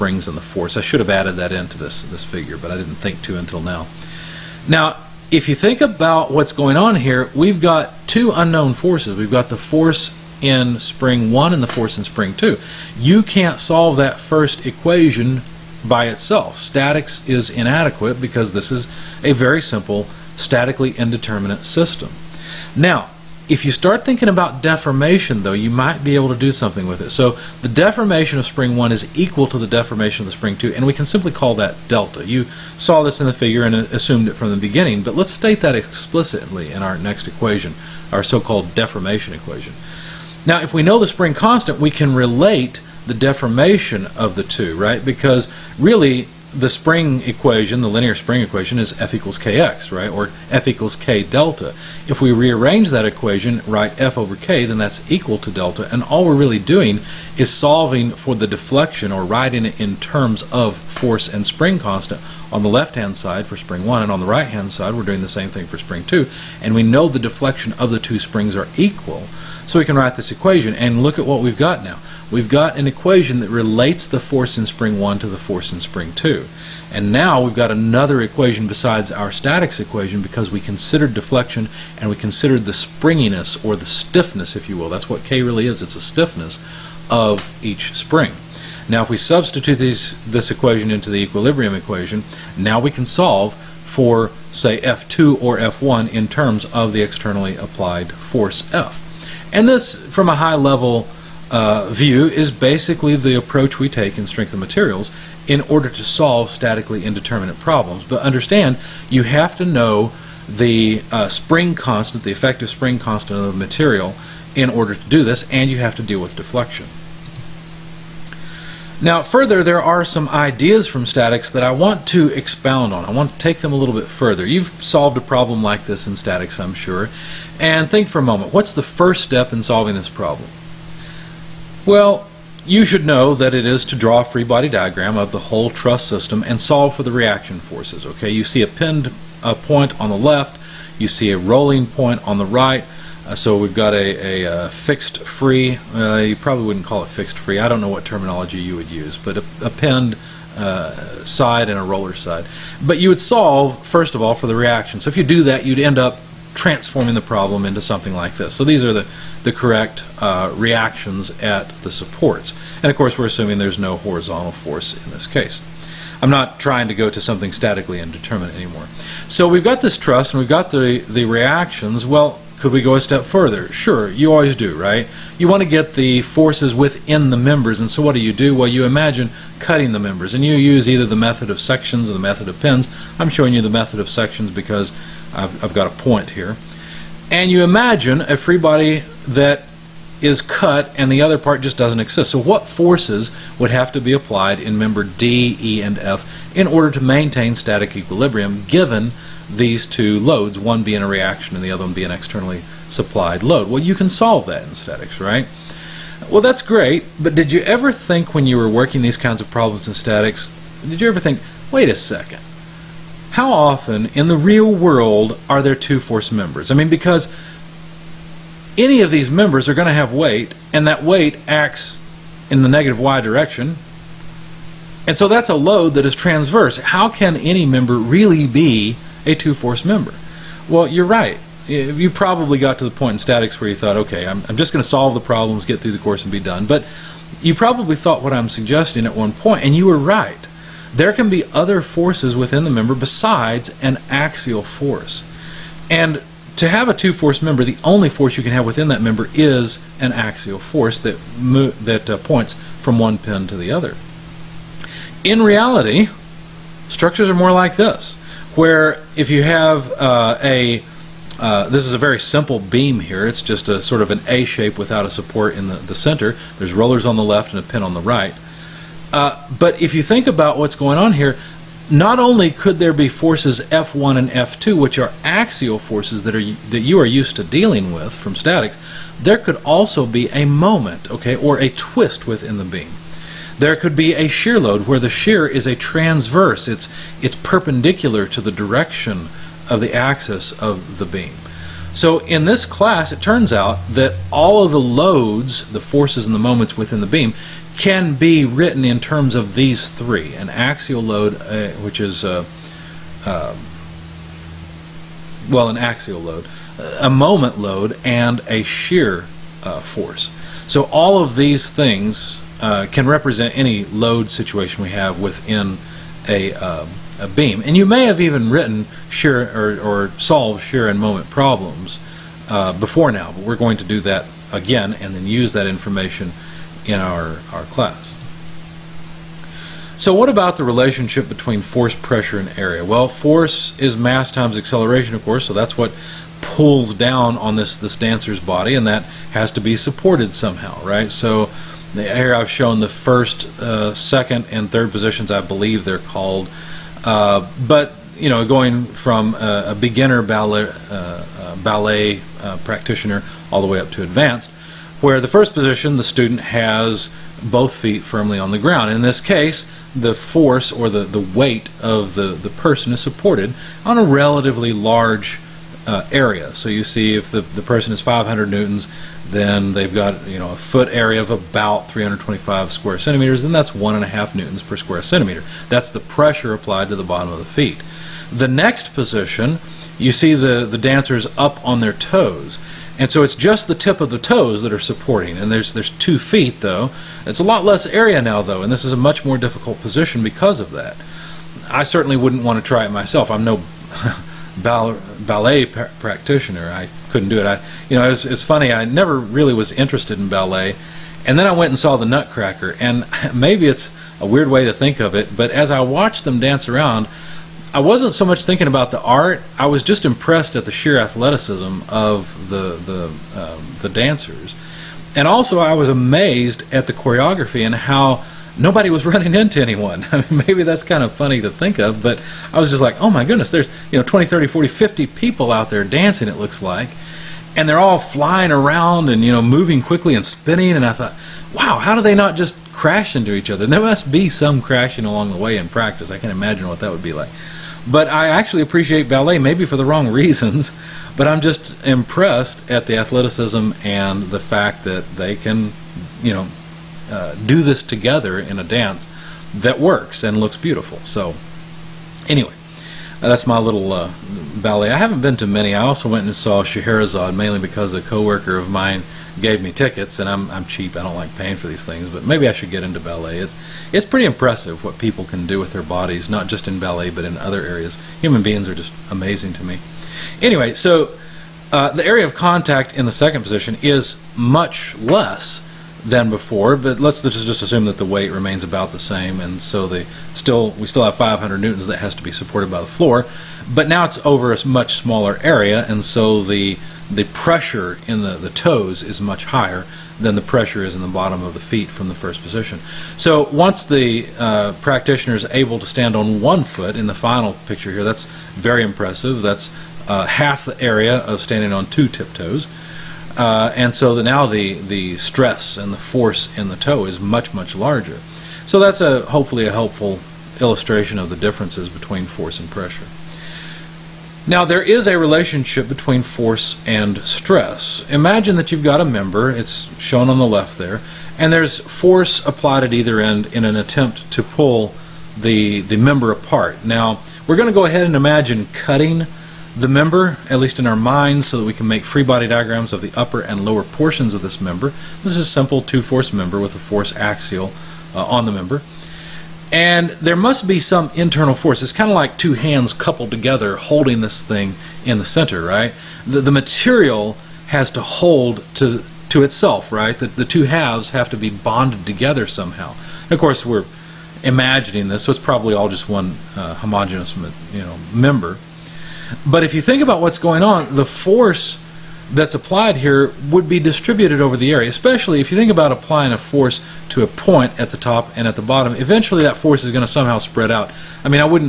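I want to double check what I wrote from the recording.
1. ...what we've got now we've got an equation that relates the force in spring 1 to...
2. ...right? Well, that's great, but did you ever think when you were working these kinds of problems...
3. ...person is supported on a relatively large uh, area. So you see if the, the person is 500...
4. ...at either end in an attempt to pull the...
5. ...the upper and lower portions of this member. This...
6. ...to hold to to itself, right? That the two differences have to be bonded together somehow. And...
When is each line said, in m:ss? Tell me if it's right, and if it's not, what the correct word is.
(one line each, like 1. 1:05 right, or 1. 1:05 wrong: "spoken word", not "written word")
1. 1:11 right
2. 3:25 right
3. 6:02 right
4. 8:42 right
5. 8:53 right
6. 9:07 wrong: "halves", not "differences".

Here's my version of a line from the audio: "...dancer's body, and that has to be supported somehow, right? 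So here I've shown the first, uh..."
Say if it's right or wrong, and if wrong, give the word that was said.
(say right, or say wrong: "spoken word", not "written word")
right.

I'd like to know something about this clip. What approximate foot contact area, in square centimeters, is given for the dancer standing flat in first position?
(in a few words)
325 square centimeters.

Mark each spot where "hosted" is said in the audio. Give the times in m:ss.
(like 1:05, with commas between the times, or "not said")
not said.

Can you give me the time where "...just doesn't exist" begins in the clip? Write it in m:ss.
3:11.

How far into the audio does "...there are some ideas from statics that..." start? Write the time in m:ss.
1:59.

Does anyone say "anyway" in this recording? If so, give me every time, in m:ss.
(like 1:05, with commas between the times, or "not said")
7:32, 7:50.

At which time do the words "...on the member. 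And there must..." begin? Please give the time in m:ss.
8:58.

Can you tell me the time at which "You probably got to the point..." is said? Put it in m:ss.
3:51.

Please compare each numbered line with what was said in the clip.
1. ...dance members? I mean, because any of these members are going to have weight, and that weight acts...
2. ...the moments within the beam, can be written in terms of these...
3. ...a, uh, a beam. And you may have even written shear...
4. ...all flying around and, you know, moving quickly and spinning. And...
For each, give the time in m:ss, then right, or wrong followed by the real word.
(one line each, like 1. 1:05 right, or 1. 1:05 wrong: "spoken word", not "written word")
1. 3:35 wrong: "force", not "dance"
2. 4:56 right
3. 5:16 right
4. 7:07 right.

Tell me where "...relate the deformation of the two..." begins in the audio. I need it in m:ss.
0:42.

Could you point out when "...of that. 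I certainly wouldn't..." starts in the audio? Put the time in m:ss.
6:30.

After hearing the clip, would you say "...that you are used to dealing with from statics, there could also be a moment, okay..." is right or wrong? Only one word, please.
right.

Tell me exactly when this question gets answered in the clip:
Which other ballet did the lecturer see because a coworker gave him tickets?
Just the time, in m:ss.
7:36.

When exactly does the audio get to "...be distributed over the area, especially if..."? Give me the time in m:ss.
9:23.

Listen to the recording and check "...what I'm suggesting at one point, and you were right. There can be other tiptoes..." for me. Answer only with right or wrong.
wrong.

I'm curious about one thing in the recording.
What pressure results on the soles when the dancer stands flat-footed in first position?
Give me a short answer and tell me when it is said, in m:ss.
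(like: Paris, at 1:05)
1.5 newtons per square centimeter, at 6:13.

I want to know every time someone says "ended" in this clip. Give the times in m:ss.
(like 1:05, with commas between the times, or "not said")
not said.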